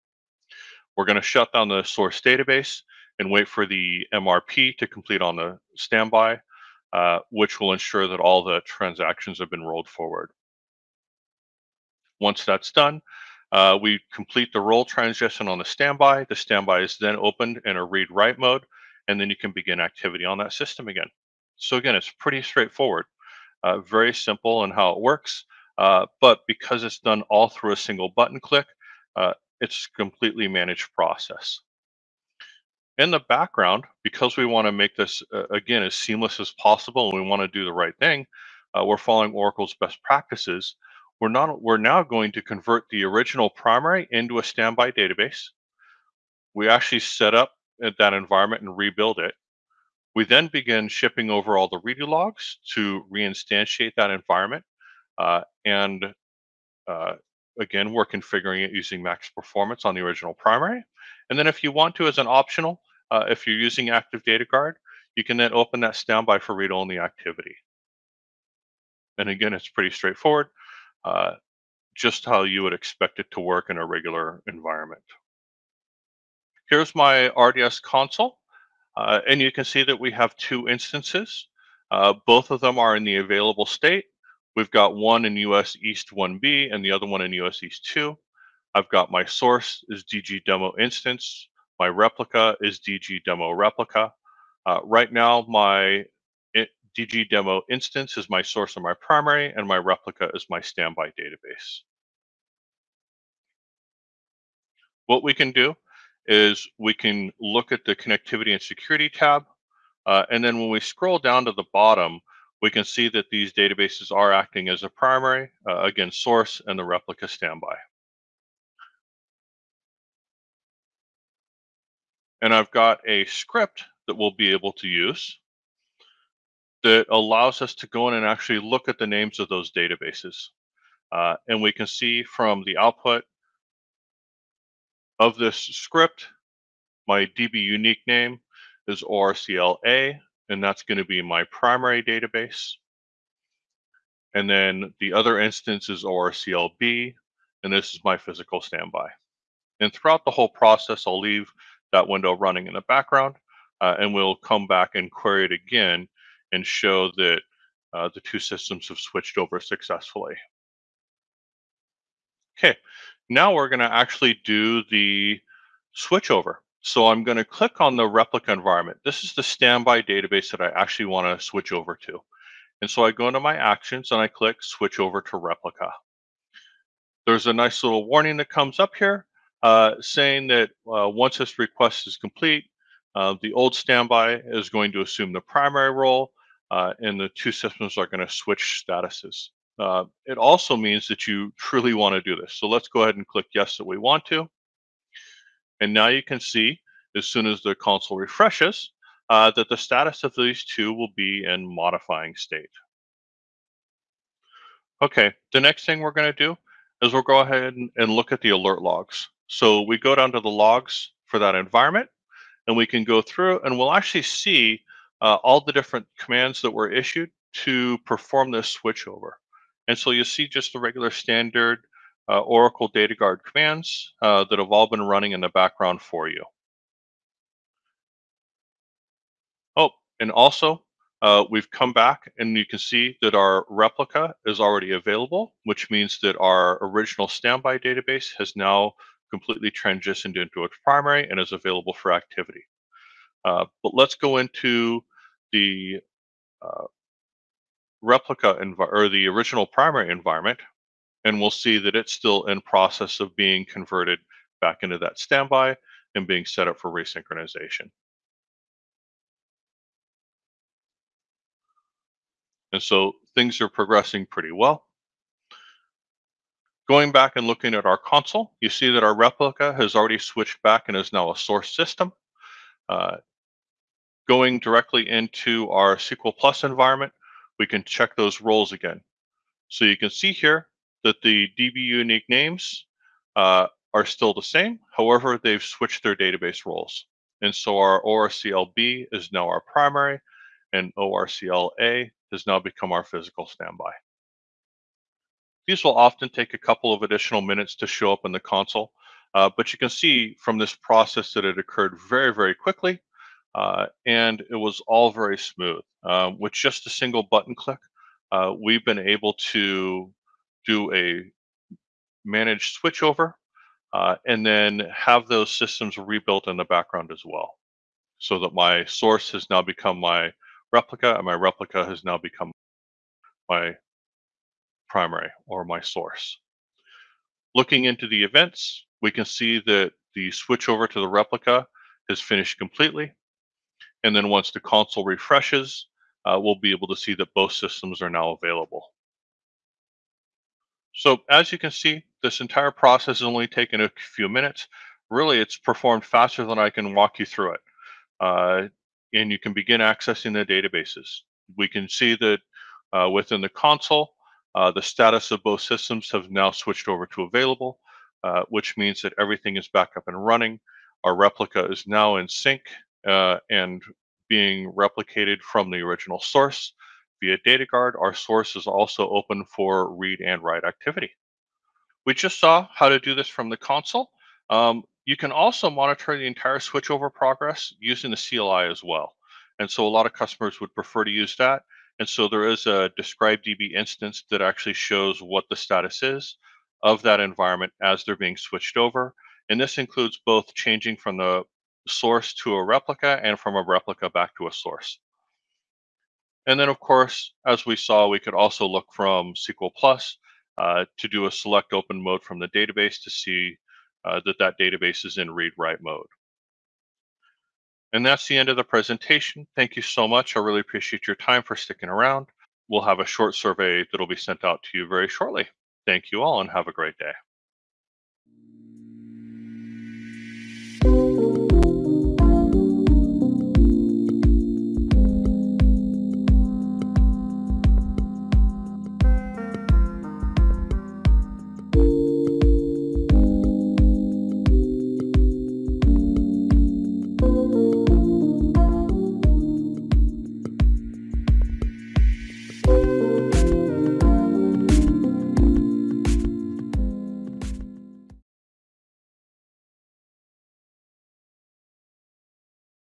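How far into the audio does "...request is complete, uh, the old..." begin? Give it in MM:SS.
03:01.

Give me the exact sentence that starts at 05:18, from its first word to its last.
So that my source has now become my replica and my replica has now become my primary or my source.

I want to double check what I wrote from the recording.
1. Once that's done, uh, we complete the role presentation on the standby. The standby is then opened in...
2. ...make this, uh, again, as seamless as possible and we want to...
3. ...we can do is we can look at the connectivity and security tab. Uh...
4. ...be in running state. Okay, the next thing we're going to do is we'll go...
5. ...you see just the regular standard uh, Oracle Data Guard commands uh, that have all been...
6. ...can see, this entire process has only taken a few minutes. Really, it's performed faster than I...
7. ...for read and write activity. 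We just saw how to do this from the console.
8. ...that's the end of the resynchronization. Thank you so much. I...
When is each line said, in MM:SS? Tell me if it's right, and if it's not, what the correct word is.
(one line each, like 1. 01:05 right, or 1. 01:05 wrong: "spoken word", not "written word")
1. 00:12 wrong: "transition", not "presentation"
2. 00:34 right
3. 01:45 right
4. 03:21 wrong: "modifying", not "running"
5. 03:40 right
6. 05:41 right
7. 06:09 right
8. 06:48 wrong: "presentation", not "resynchronization".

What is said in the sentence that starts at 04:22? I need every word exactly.
And so things are progressing pretty well.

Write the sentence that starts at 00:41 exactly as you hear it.
We're, not, we're now going to convert the original primary into a standby database.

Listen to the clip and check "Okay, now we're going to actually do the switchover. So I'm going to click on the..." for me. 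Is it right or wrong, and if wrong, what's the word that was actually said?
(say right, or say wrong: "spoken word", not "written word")
right.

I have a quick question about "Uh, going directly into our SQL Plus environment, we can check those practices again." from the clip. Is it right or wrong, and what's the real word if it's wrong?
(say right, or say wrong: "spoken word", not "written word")
wrong: "roles", not "practices".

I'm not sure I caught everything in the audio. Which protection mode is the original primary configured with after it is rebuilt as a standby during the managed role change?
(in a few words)
max performance.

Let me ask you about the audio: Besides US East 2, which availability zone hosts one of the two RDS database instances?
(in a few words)
US East 1B.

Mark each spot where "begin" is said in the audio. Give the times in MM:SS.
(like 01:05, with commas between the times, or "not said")
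00:19, 00:50, 05:49.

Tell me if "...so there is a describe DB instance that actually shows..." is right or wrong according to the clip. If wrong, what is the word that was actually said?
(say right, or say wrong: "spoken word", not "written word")
right.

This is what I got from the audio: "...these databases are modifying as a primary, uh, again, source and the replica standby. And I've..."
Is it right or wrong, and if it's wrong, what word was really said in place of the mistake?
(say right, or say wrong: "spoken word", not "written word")
wrong: "acting", not "modifying".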